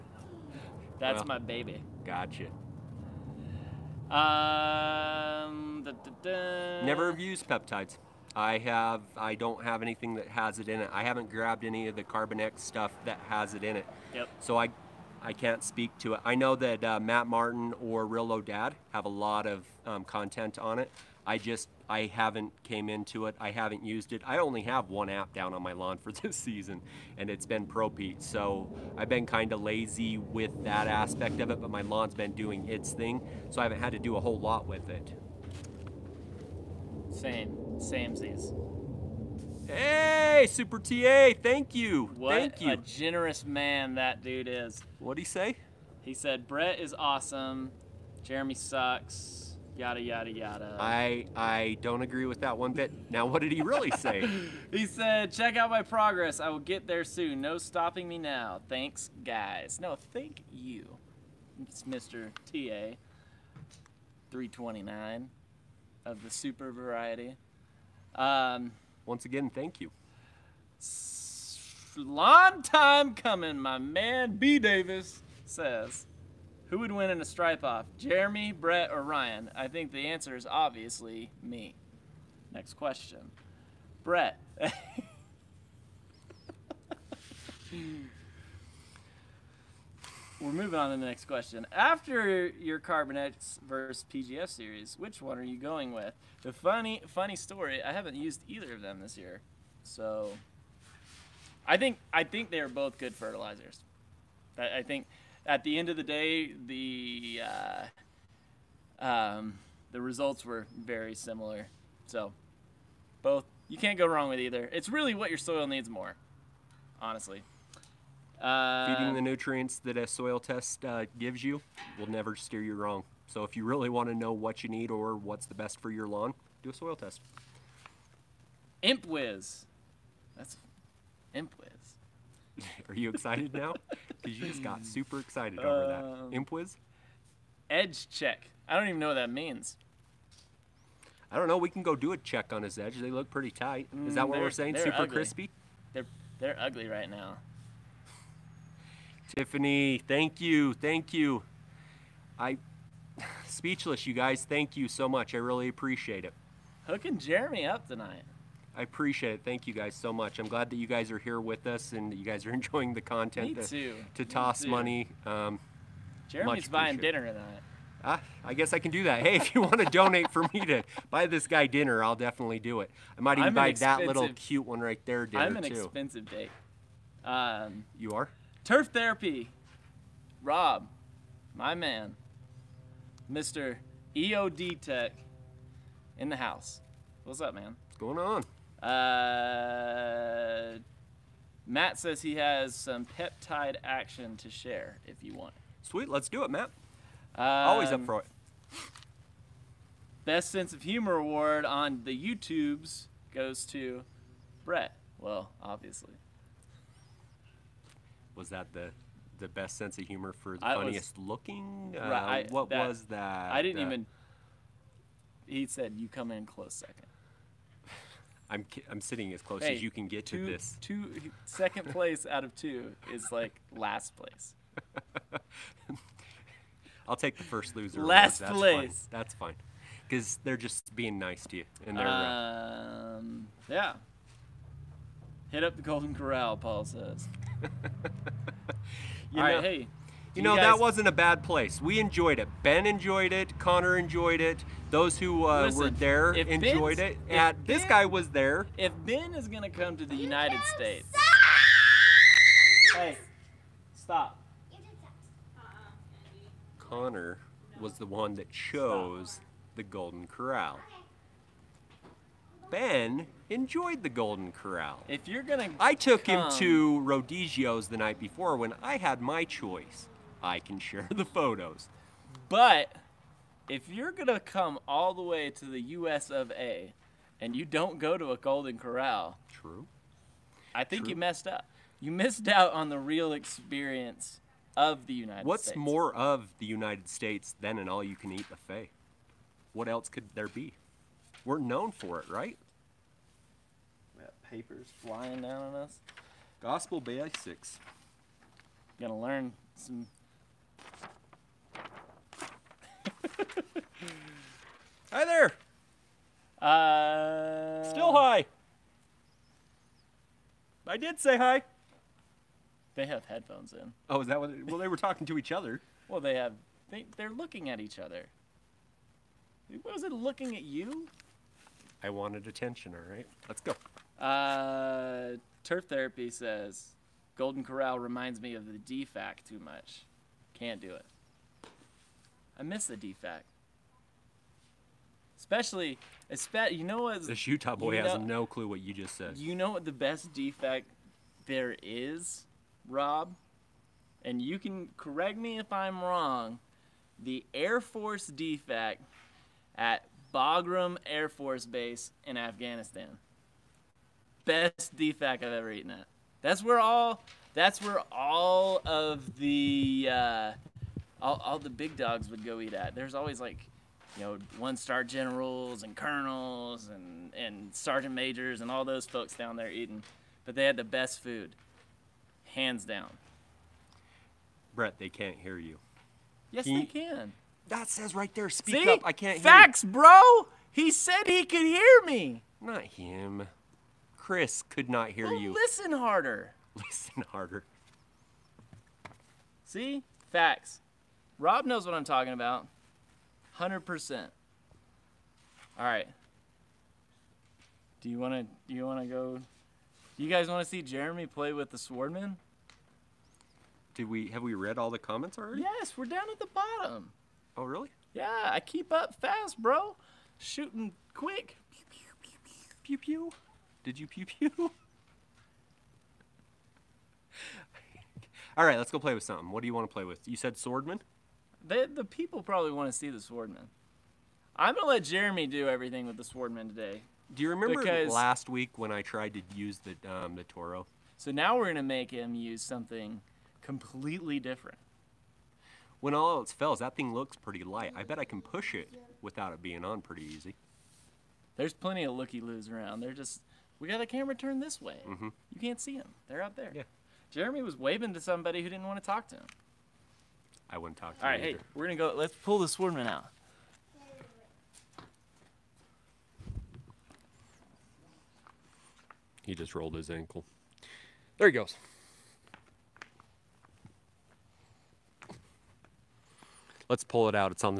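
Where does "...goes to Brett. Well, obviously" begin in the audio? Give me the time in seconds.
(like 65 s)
203 s.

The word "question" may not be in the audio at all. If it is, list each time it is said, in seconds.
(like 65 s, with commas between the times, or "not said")
82 s, 91 s.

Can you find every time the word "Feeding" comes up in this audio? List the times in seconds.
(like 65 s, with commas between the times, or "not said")
118 s.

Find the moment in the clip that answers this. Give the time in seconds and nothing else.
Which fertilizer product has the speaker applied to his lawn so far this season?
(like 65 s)
27 s.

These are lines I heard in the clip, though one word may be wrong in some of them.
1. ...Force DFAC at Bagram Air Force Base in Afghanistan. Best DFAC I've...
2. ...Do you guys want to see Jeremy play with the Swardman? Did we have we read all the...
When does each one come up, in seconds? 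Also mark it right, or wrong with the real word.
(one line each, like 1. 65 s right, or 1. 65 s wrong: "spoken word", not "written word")
1. 347 s right
2. 400 s right.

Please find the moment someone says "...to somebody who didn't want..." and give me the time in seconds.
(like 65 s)
448 s.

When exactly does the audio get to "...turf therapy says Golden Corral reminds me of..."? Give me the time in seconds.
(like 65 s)
325 s.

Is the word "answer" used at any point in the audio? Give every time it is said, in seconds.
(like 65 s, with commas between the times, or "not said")
80 s.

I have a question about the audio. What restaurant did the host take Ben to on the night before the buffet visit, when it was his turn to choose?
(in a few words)
Rodizio's.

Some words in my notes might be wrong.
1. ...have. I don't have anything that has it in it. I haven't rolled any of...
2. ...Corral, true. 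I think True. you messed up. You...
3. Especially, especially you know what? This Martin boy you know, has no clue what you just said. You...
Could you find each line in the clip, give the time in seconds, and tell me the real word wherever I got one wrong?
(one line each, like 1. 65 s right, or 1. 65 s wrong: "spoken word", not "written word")
1. 8 s wrong: "grabbed", not "rolled"
2. 278 s right
3. 335 s wrong: "Utah", not "Martin".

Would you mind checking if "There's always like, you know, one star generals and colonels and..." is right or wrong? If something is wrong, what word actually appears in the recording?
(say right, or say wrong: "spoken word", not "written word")
right.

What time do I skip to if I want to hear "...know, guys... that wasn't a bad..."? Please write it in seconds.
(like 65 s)
240 s.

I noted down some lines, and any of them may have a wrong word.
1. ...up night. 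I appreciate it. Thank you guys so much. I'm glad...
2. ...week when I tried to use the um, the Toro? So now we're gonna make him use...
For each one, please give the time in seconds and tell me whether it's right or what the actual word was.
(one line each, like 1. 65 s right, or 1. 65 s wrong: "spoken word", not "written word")
1. 157 s wrong: "tonight", not "night"
2. 428 s right.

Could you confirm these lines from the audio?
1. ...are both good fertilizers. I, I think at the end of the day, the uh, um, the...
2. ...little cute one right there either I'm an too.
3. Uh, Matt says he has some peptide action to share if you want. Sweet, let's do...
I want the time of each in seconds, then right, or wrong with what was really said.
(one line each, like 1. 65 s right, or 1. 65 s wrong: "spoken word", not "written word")
1. 102 s right
2. 174 s wrong: "dinner", not "either"
3. 188 s right.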